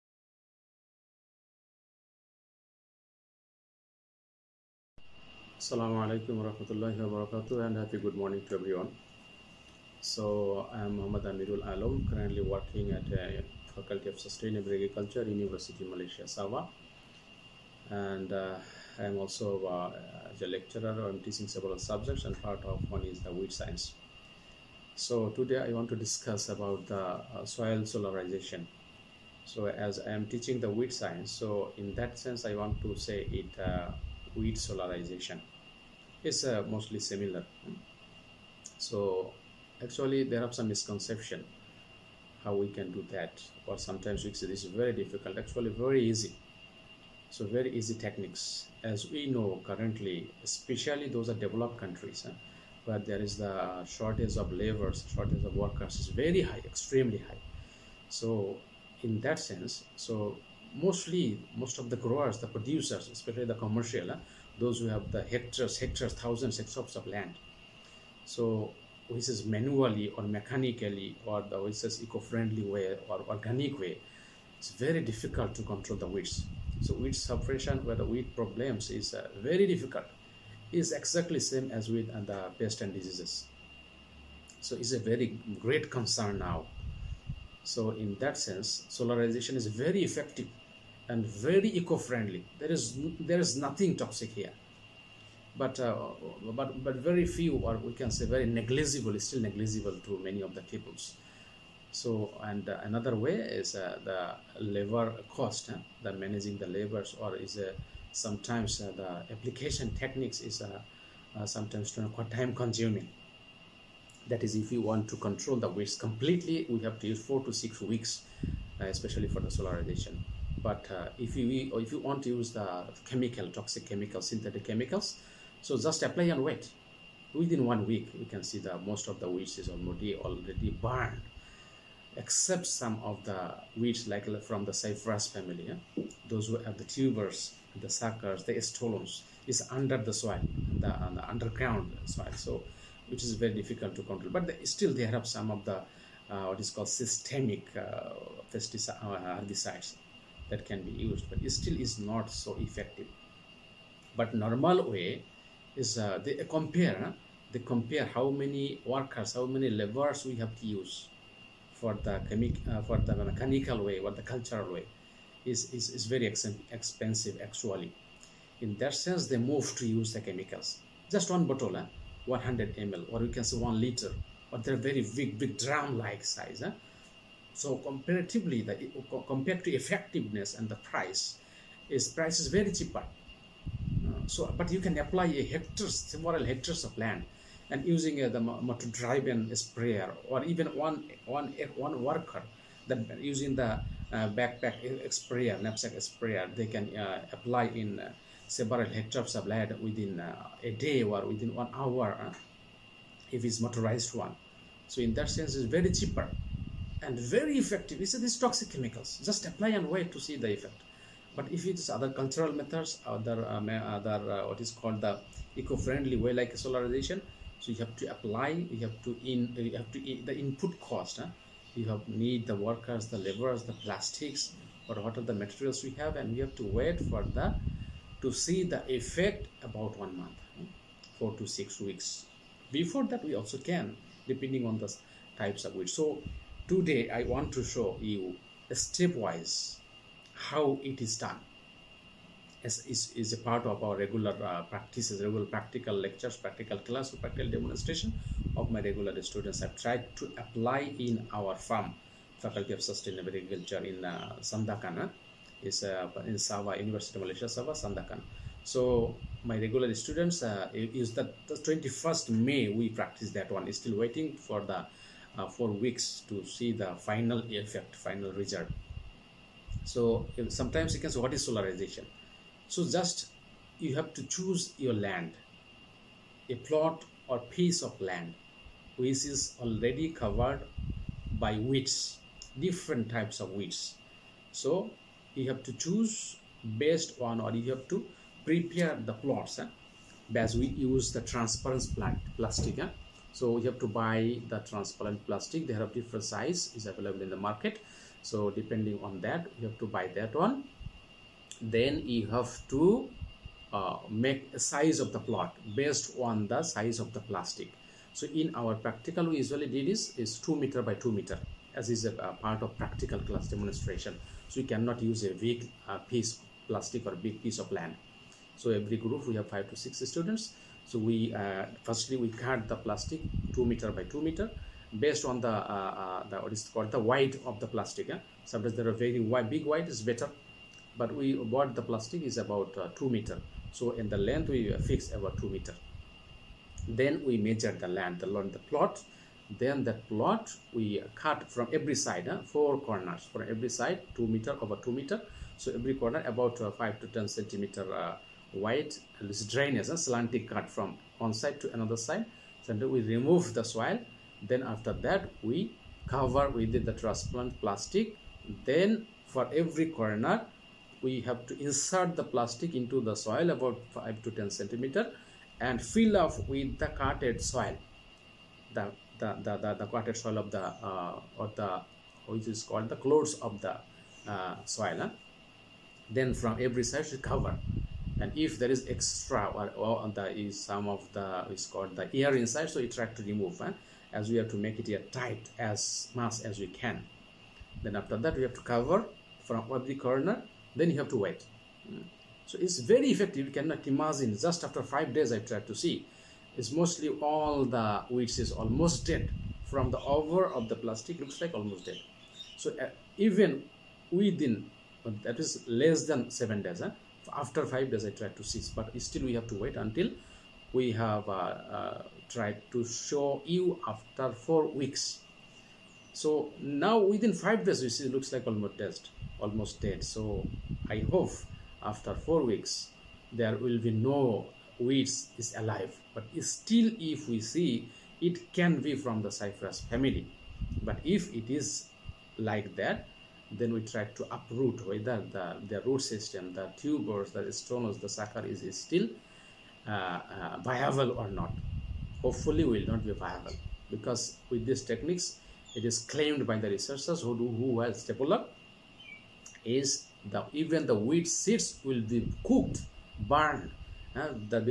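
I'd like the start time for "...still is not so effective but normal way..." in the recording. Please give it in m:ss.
2:31.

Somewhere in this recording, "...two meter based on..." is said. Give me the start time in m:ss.
5:24.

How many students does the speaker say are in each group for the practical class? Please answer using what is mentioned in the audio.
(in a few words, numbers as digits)
5 to 6.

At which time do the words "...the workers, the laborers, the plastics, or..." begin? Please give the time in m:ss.
3:42.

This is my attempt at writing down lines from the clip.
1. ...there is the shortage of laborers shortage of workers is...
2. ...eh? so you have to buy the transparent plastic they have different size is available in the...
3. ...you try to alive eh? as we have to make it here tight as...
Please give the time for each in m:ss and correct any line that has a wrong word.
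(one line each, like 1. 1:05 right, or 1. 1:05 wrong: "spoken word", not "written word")
1. 0:53 right
2. 4:52 right
3. 6:22 wrong: "remove", not "alive".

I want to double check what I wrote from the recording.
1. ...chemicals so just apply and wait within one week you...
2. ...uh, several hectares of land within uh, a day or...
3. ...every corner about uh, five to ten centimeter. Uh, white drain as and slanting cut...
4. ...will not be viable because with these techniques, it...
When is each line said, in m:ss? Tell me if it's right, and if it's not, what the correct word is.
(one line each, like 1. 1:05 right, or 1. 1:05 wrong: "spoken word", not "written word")
1. 2:04 right
2. 3:18 right
3. 5:45 right
4. 7:22 right.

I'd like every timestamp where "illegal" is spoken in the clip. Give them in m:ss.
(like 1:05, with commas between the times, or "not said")
not said.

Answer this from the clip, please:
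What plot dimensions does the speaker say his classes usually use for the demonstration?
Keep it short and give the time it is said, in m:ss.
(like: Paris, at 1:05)
2 meter by 2 meter, at 5:10.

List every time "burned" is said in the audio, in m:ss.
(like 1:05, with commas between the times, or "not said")
2:10, 7:33.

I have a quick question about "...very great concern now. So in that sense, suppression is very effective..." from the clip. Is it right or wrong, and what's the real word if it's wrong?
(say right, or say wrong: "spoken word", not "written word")
wrong: "solarization", not "suppression".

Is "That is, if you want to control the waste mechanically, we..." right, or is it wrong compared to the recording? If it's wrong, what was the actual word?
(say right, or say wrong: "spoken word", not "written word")
wrong: "completely", not "mechanically".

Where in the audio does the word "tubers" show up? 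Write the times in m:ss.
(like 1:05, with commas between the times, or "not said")
2:16, 7:16.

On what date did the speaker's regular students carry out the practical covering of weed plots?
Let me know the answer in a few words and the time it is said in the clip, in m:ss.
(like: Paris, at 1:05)
21 May, at 4:21.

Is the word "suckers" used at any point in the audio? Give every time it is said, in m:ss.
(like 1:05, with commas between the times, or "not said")
2:17, 7:18.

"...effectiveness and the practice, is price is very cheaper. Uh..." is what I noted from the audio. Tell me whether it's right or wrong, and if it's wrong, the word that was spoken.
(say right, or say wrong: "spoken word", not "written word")
wrong: "price", not "practice".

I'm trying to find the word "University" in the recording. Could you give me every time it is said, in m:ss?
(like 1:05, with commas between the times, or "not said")
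0:15, 4:16.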